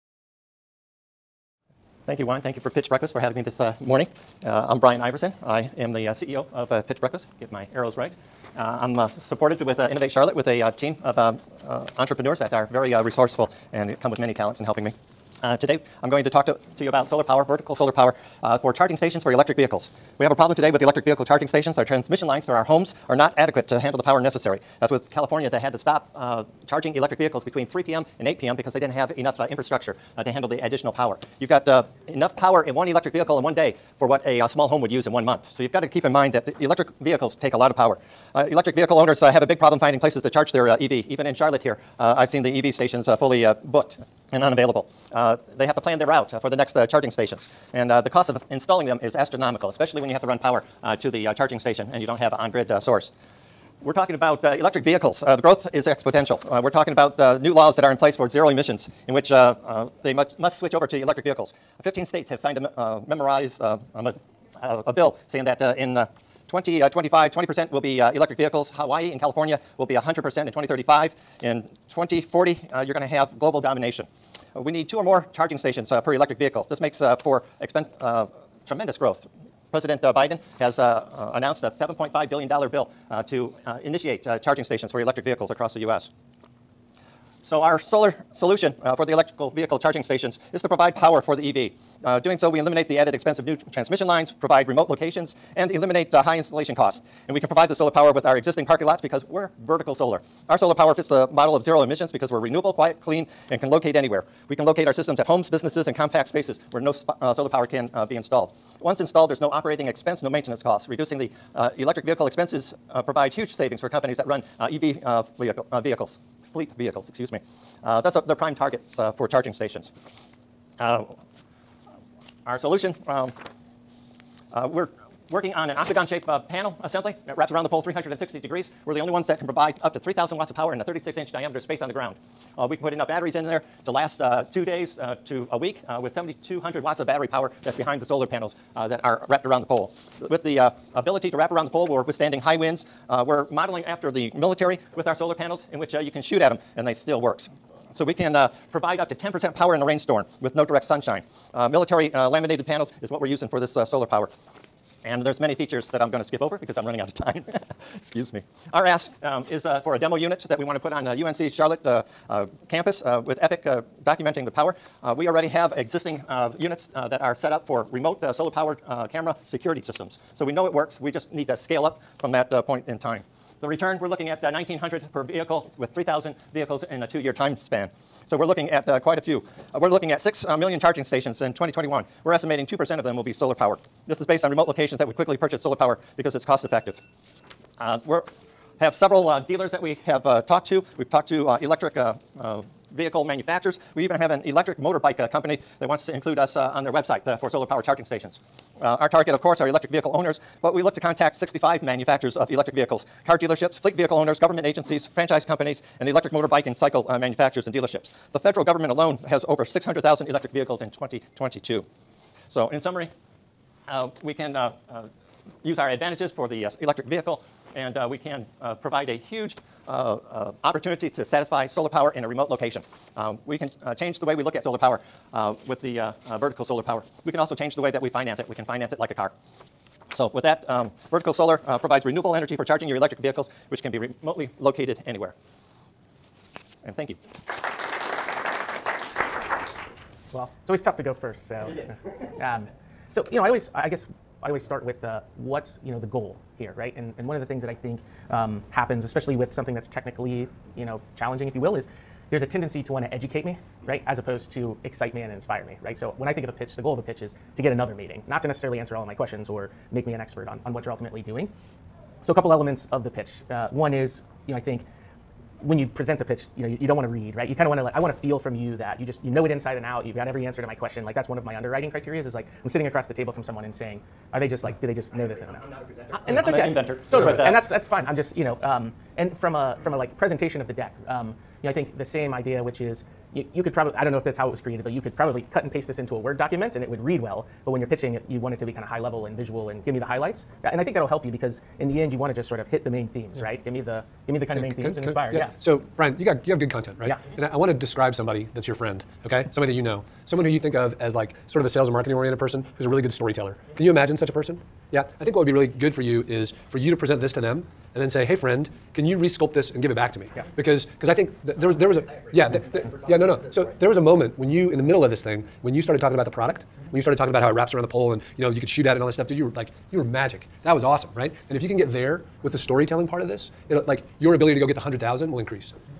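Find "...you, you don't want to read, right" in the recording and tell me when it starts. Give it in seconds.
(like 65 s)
266 s.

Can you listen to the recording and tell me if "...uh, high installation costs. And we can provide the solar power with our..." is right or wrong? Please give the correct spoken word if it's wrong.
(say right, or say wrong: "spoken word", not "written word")
right.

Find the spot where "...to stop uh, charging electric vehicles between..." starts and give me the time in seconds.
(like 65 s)
25 s.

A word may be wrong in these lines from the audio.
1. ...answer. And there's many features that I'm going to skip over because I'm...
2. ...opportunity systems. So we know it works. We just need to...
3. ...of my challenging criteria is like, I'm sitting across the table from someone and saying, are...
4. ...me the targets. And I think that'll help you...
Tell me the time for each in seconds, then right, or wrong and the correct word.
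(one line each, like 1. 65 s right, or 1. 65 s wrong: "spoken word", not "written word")
1. 154 s wrong: "power", not "answer"
2. 169 s wrong: "security", not "opportunity"
3. 271 s wrong: "underwriting", not "challenging"
4. 289 s wrong: "highlights", not "targets".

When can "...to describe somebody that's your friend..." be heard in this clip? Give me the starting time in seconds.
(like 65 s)
297 s.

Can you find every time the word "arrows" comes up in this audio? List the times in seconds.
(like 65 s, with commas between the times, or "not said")
7 s.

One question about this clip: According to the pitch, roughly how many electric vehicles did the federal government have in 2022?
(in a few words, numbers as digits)
600,000.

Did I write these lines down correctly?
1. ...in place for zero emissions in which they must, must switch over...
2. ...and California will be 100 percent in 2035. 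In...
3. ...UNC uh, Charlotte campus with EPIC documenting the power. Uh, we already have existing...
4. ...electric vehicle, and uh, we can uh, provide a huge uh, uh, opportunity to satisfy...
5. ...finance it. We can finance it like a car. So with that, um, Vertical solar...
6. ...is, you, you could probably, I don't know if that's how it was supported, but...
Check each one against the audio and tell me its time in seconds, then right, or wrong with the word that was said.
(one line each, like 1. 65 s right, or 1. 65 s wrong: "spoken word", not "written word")
1. 57 s right
2. 69 s right
3. 161 s right
4. 216 s right
5. 228 s right
6. 282 s wrong: "created", not "supported".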